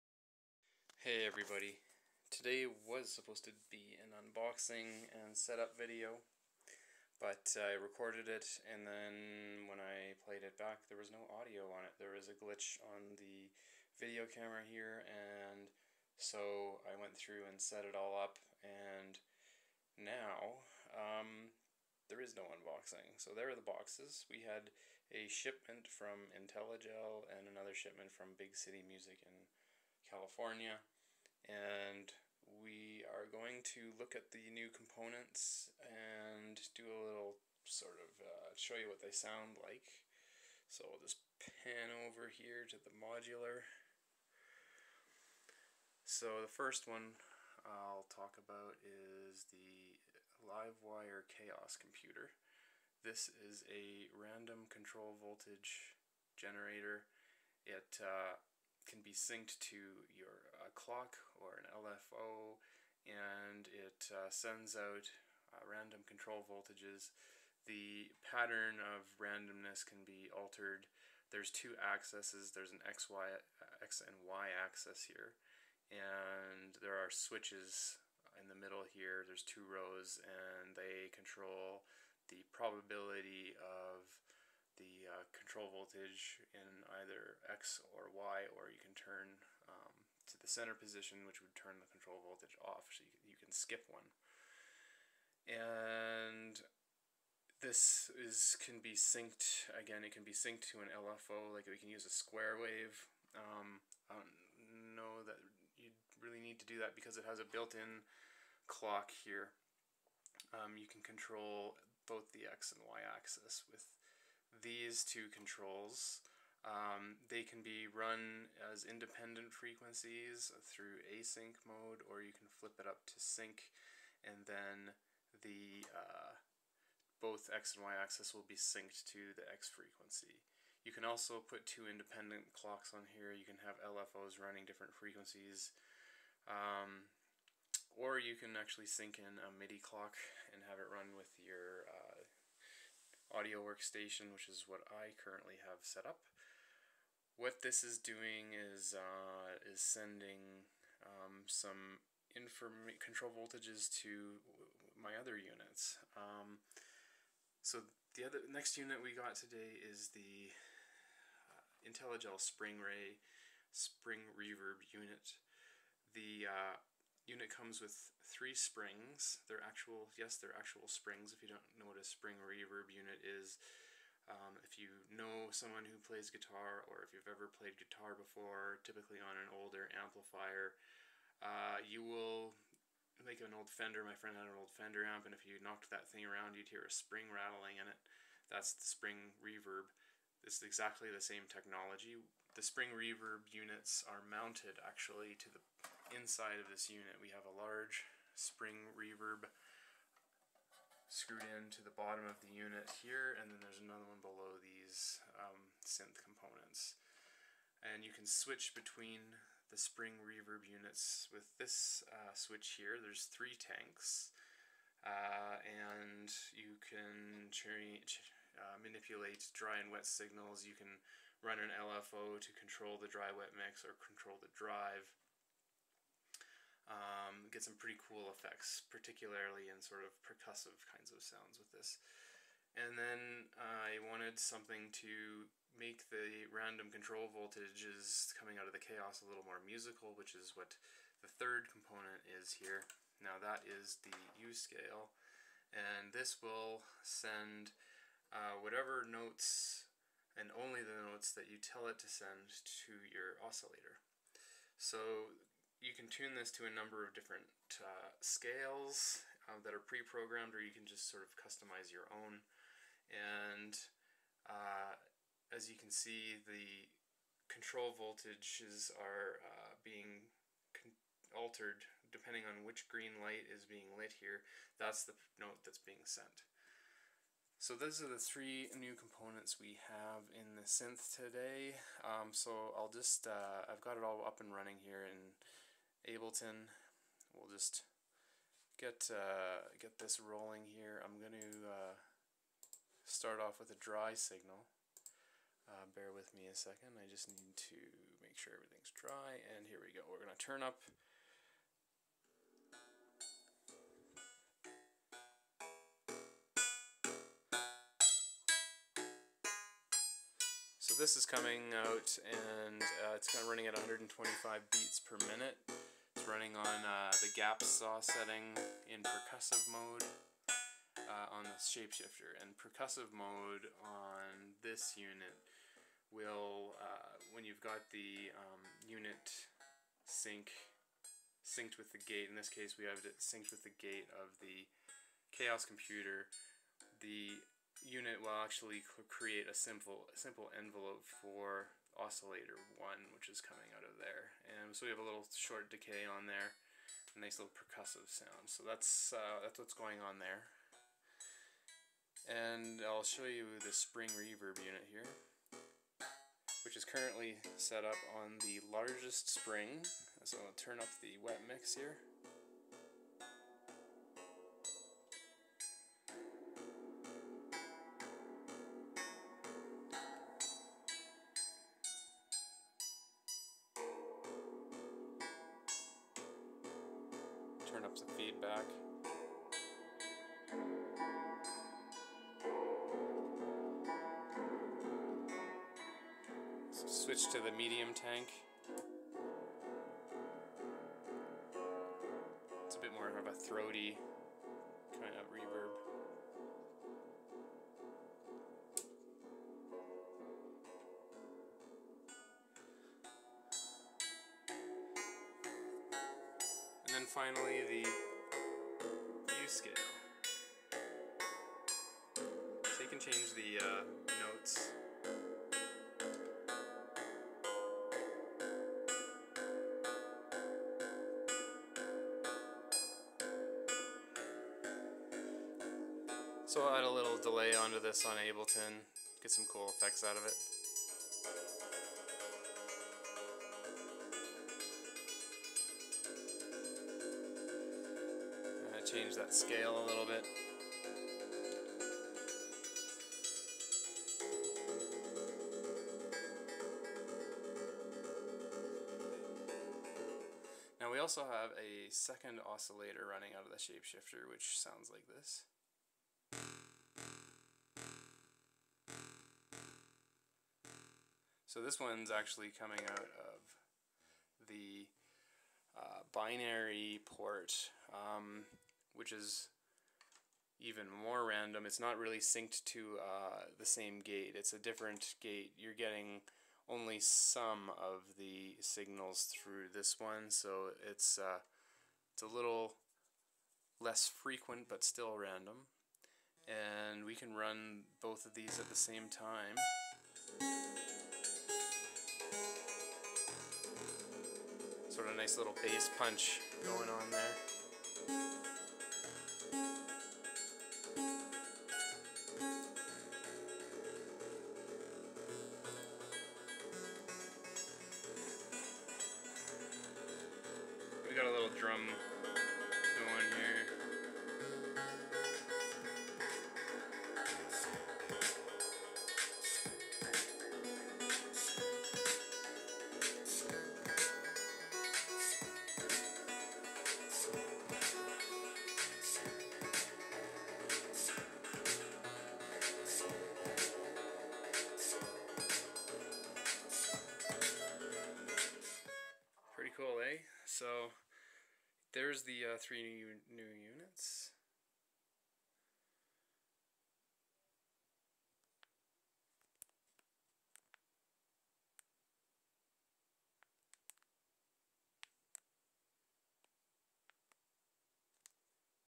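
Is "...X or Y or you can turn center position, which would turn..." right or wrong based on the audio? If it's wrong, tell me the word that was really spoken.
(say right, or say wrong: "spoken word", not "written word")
right.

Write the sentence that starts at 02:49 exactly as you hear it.
They're actual, yes, they're actual springs.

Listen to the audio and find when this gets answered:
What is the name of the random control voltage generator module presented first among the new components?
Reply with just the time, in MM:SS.
00:50.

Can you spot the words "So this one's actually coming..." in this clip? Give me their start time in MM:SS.
07:41.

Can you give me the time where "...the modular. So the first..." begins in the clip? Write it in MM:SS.
00:42.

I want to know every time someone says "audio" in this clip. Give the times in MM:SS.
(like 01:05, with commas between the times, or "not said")
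00:11, 02:23.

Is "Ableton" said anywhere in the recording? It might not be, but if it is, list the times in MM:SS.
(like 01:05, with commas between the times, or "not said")
04:46, 07:08.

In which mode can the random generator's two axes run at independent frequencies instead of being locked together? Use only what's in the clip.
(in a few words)
async mode.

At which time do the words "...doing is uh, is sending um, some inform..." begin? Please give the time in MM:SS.
02:27.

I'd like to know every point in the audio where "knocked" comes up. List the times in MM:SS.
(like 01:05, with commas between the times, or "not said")
03:05.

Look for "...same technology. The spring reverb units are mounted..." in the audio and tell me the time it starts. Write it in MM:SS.
03:11.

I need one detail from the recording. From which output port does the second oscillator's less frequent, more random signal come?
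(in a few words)
binary port.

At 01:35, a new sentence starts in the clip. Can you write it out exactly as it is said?
And this is can be synced, again, it can be synced to an LFO, like we can use a square wave.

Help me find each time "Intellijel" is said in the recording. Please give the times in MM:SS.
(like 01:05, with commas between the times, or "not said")
00:26, 02:41.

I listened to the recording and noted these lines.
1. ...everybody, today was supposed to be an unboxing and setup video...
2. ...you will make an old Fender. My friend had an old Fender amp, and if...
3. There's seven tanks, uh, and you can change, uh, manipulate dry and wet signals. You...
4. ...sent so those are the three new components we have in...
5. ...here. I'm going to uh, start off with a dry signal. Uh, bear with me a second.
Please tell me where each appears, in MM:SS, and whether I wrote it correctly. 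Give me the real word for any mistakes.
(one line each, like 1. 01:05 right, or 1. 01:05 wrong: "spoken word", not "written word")
1. 00:01 right
2. 03:01 right
3. 03:32 wrong: "three", not "seven"
4. 04:36 right
5. 04:50 right.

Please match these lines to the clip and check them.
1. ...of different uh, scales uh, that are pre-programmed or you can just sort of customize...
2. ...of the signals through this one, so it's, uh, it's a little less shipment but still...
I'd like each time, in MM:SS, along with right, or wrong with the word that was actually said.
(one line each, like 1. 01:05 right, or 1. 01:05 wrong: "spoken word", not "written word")
1. 04:17 right
2. 07:57 wrong: "frequent", not "shipment".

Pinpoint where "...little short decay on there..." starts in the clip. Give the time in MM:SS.
05:45.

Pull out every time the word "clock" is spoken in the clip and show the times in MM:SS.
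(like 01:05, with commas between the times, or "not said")
01:00, 01:48, 02:12, 02:19.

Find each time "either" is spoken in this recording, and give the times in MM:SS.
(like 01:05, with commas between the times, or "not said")
01:27.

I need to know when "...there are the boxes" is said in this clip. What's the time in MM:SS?
00:23.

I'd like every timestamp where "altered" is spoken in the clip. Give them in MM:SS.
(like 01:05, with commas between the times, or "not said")
01:10, 04:31.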